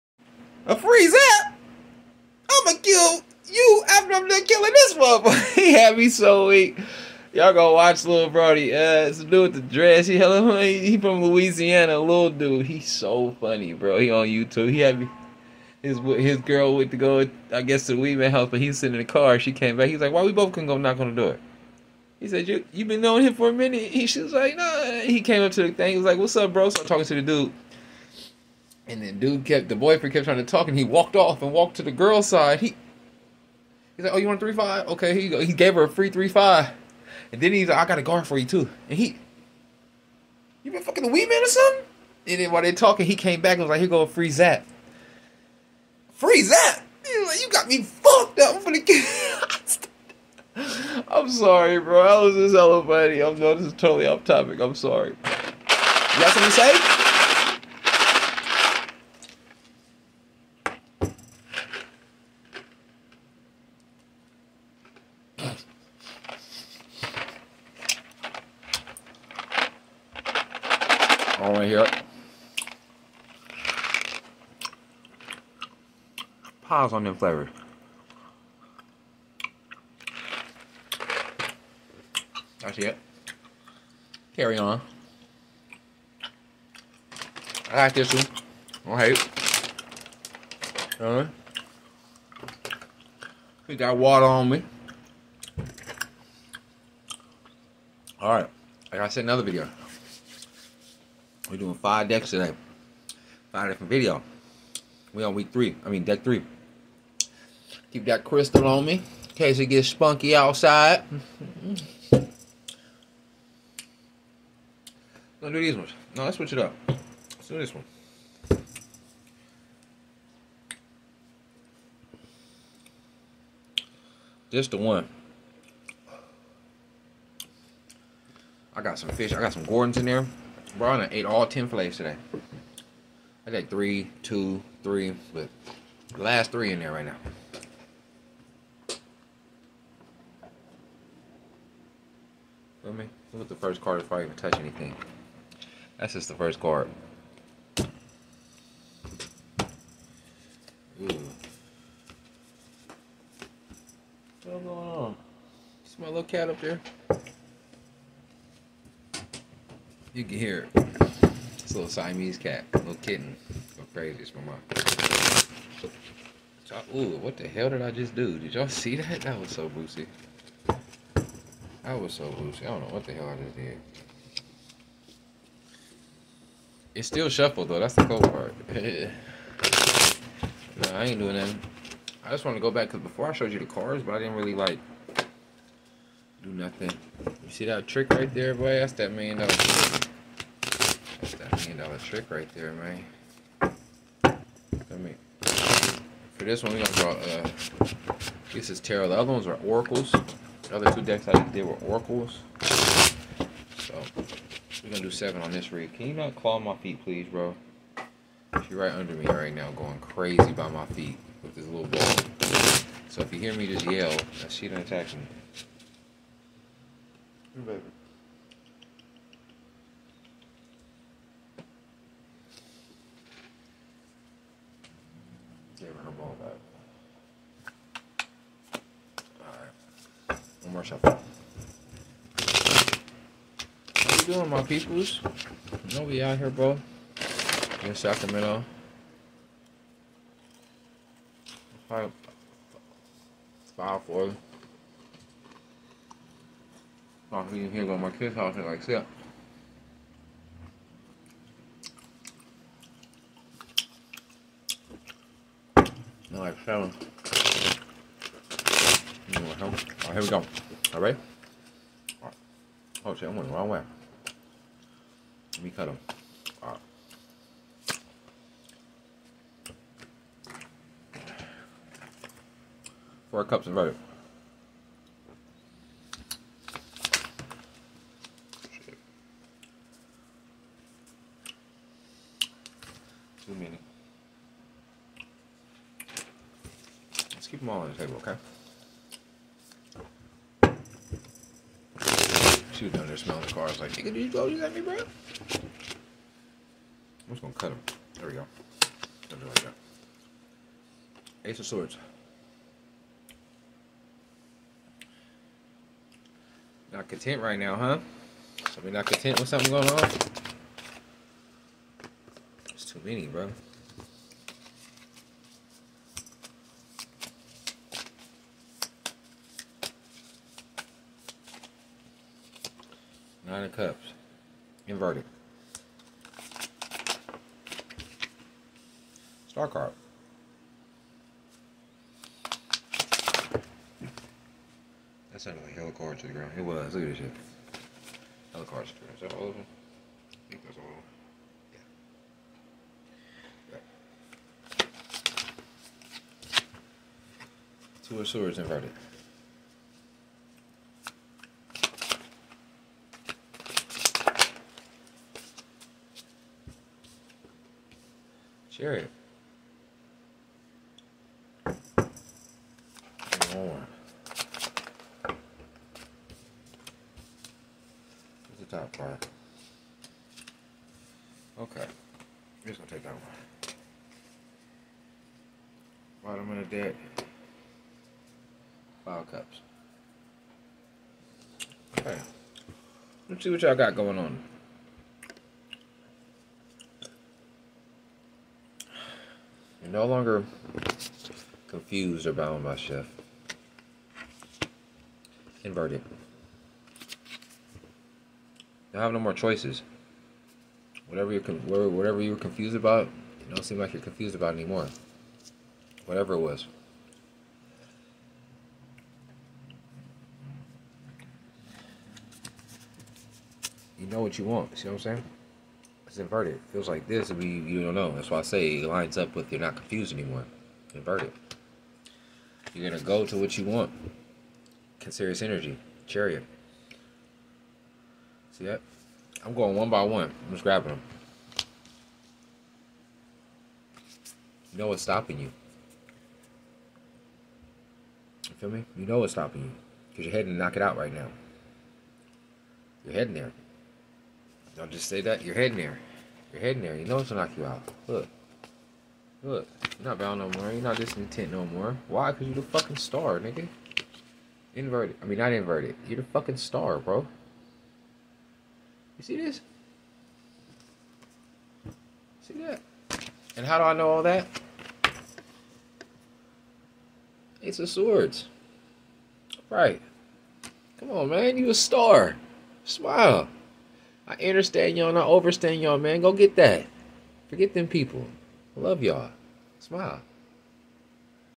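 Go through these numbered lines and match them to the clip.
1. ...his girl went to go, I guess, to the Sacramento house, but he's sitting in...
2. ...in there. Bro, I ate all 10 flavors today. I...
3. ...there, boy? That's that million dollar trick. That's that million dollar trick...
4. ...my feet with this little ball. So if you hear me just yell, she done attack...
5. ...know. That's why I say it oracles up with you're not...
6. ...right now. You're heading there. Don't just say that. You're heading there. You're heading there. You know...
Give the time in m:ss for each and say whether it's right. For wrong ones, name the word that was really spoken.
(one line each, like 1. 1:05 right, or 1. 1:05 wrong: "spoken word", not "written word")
1. 0:15 wrong: "Weedman", not "Sacramento"
2. 2:09 right
3. 3:08 right
4. 3:30 right
5. 6:57 wrong: "lines", not "oracles"
6. 7:20 right.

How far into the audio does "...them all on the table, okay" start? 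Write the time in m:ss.
4:47.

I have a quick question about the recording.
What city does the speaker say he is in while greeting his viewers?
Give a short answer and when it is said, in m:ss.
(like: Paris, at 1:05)
Sacramento, at 3:57.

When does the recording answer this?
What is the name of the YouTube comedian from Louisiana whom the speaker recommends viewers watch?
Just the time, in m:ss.
0:08.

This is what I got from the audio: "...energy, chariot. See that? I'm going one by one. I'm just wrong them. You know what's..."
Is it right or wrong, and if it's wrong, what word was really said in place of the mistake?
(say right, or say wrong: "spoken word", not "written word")
wrong: "grabbing", not "wrong".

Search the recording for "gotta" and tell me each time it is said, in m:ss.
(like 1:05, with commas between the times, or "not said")
1:38.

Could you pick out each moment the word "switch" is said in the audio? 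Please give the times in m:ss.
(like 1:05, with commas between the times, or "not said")
1:56.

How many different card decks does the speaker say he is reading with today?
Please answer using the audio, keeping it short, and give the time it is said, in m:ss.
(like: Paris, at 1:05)
5, at 1:41.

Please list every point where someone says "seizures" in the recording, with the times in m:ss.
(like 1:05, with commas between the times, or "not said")
not said.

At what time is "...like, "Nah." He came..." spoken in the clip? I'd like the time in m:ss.
0:24.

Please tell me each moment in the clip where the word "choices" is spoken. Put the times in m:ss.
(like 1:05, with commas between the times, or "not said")
6:39.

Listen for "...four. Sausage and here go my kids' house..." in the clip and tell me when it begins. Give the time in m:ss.
4:04.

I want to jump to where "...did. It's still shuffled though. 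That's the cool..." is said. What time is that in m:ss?
2:53.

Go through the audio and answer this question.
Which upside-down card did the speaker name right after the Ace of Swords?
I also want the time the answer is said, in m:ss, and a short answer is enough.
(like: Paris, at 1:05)
Nine of Cups, at 5:23.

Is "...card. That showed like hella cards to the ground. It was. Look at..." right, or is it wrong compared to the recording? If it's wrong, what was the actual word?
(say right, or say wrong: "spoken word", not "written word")
wrong: "sounded", not "showed".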